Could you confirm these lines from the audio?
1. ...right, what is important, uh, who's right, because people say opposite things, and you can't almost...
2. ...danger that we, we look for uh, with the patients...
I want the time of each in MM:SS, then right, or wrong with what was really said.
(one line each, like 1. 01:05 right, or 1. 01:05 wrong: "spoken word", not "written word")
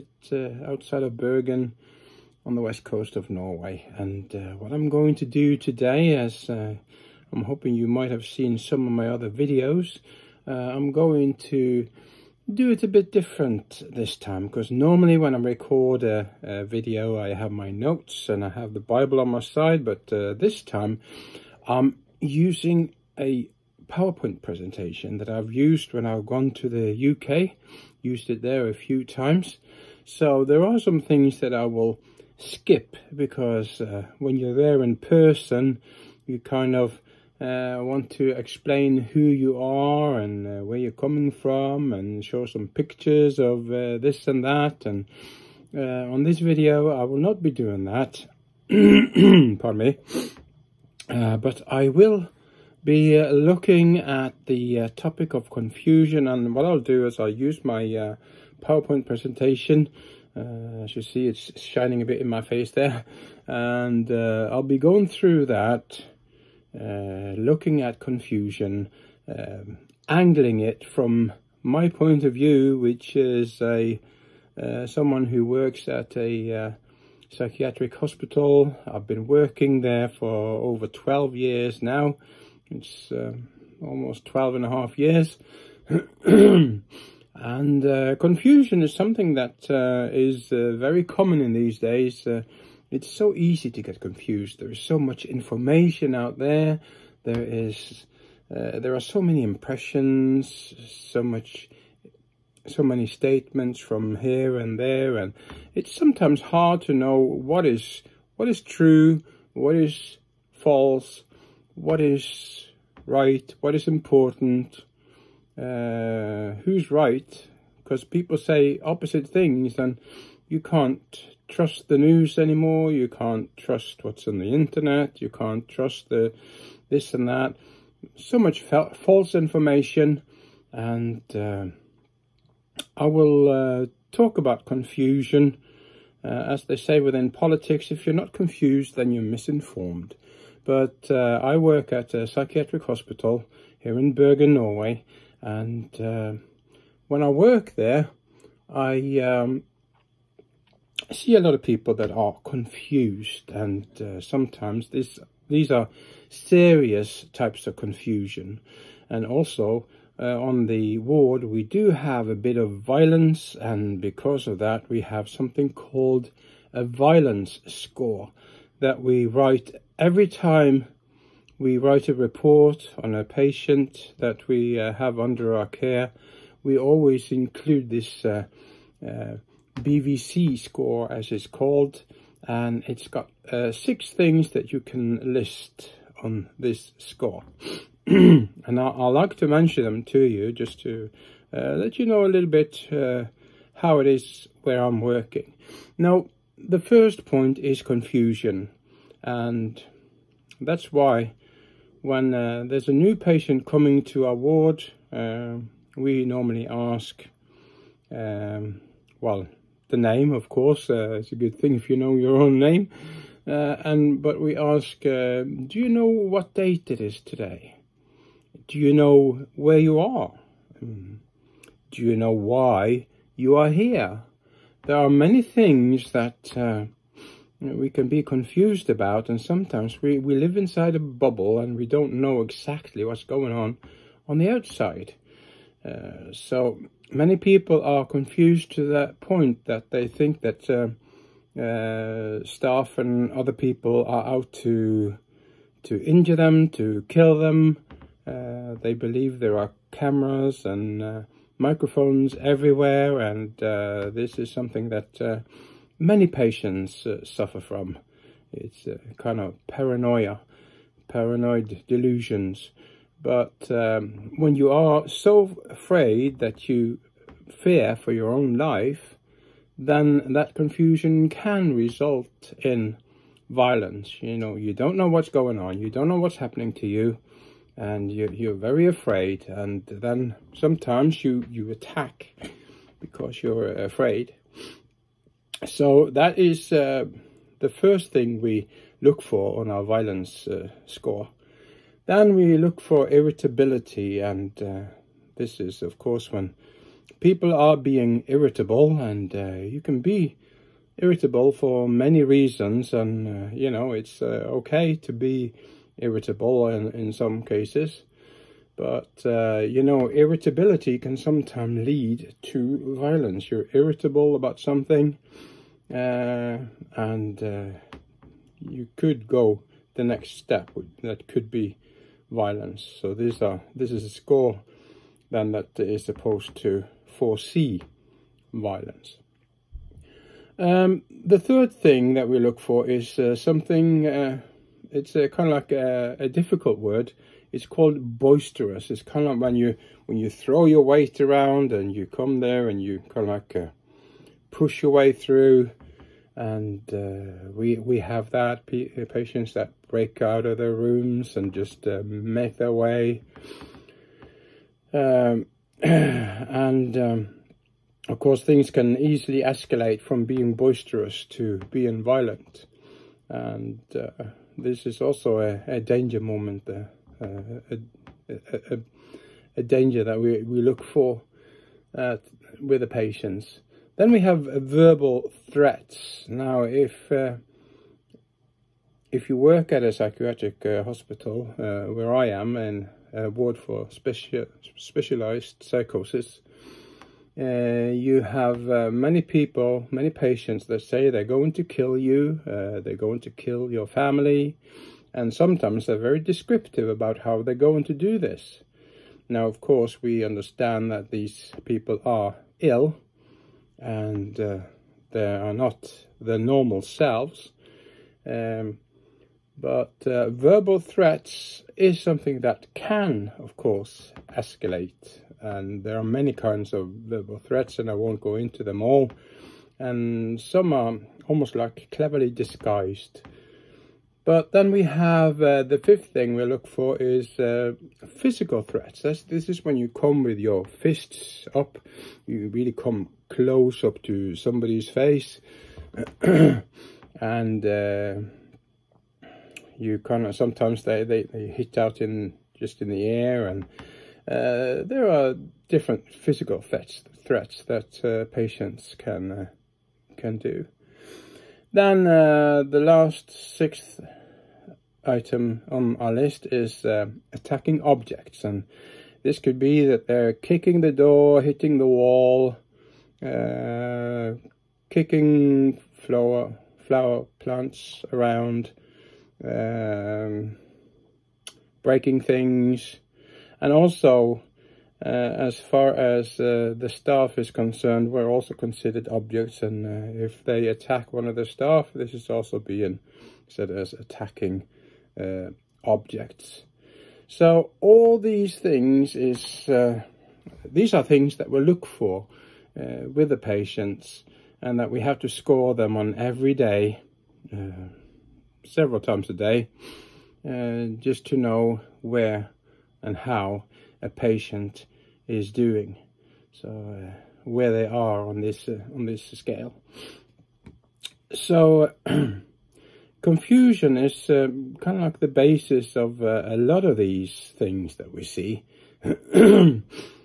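1. 01:53 wrong: "trust", not "almost"
2. 06:09 right.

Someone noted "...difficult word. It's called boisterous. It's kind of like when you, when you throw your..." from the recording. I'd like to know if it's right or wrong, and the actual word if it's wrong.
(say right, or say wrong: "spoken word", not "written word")
right.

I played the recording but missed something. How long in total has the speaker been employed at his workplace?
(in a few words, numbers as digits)
12 and a half years.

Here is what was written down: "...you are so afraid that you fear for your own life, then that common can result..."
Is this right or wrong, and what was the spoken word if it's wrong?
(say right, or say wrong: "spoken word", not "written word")
wrong: "confusion", not "common".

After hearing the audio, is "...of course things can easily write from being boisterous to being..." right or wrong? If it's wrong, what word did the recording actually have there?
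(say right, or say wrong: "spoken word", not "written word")
wrong: "escalate", not "write".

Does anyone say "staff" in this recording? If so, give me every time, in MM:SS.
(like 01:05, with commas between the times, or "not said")
04:02, 07:56, 08:01.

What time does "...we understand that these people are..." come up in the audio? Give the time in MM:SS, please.
06:40.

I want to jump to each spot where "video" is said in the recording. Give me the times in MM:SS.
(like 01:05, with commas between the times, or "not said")
00:09, 00:16, 00:46.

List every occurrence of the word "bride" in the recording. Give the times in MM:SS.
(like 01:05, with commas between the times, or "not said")
not said.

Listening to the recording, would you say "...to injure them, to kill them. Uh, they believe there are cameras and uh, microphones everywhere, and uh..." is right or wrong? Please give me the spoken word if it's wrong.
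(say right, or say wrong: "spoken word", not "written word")
right.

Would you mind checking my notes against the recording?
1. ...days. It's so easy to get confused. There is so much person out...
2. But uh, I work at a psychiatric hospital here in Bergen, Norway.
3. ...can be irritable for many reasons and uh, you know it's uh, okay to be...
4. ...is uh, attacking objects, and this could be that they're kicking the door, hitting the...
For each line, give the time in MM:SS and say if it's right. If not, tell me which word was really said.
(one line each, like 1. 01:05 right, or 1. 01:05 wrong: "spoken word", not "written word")
1. 01:31 wrong: "information", not "person"
2. 02:20 right
3. 04:59 right
4. 07:36 right.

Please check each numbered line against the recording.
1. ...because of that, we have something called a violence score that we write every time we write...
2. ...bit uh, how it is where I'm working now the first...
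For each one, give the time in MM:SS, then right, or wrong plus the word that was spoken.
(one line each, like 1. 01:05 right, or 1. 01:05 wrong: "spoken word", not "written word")
1. 02:43 right
2. 03:12 right.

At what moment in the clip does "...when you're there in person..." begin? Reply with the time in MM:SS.
00:34.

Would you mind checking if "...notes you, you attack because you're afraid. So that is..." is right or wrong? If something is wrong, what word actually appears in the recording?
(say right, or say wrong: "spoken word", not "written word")
wrong: "sometimes", not "notes".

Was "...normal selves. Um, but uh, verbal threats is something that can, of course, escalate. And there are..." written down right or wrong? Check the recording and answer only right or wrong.
right.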